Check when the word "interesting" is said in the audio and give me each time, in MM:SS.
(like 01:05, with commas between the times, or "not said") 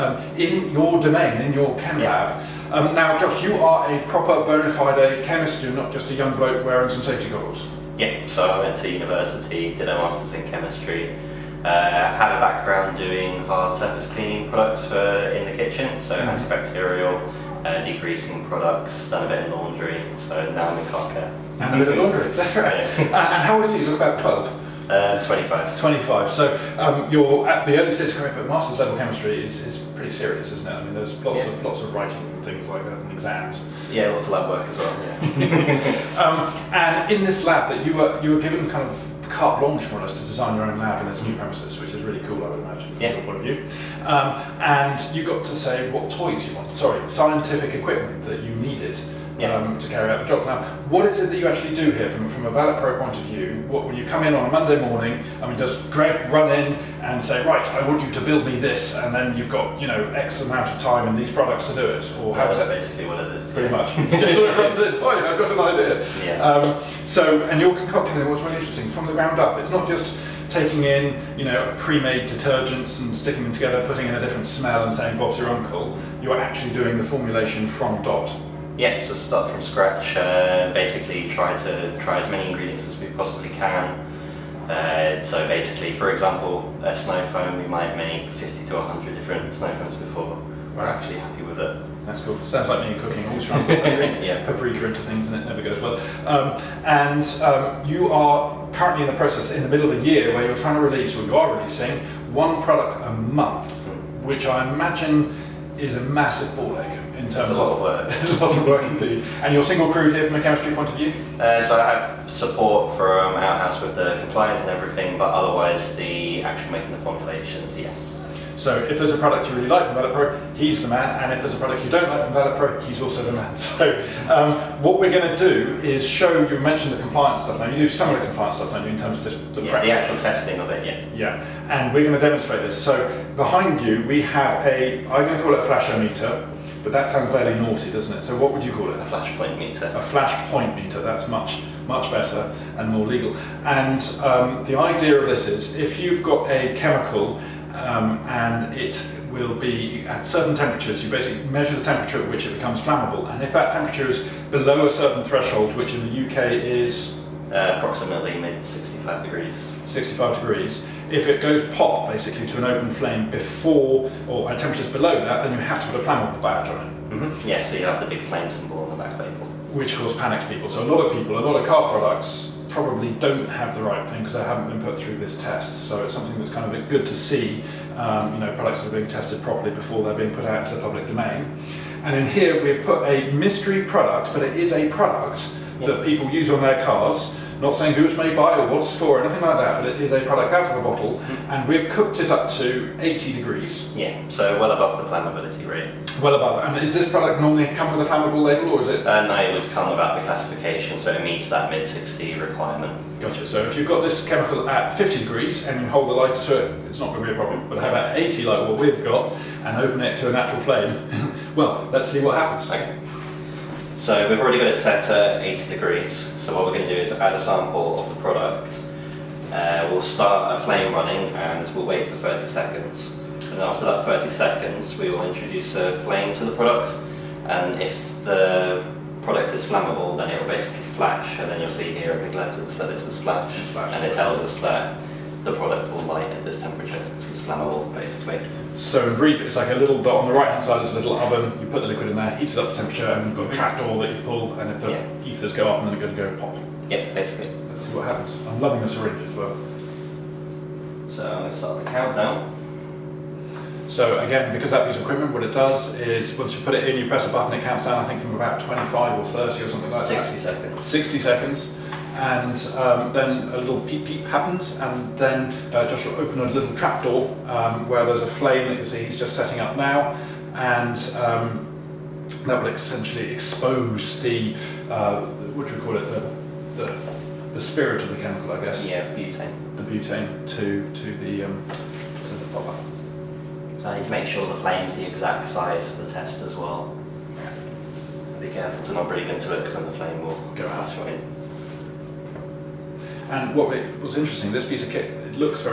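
01:08, 04:54.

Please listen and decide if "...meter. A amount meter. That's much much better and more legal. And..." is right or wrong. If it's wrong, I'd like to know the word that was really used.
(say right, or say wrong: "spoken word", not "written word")
wrong: "flashpoint", not "amount".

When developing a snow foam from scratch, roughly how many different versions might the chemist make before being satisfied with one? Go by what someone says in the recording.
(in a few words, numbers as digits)
50 to 100.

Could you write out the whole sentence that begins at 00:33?
Yeah, lots of lab work as well.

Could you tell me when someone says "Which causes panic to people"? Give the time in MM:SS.
02:49.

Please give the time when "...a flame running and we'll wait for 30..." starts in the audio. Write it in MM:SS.
03:40.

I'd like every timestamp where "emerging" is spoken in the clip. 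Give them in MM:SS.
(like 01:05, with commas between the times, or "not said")
not said.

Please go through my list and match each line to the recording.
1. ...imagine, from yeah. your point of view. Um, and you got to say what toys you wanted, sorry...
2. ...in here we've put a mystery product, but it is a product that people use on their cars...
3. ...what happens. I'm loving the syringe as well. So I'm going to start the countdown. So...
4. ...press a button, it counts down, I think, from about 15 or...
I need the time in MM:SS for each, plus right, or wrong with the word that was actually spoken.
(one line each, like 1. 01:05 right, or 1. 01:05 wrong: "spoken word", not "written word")
1. 00:42 right
2. 03:02 right
3. 04:07 right
4. 04:17 wrong: "25", not "15".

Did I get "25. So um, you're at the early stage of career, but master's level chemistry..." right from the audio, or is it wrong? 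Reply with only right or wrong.
right.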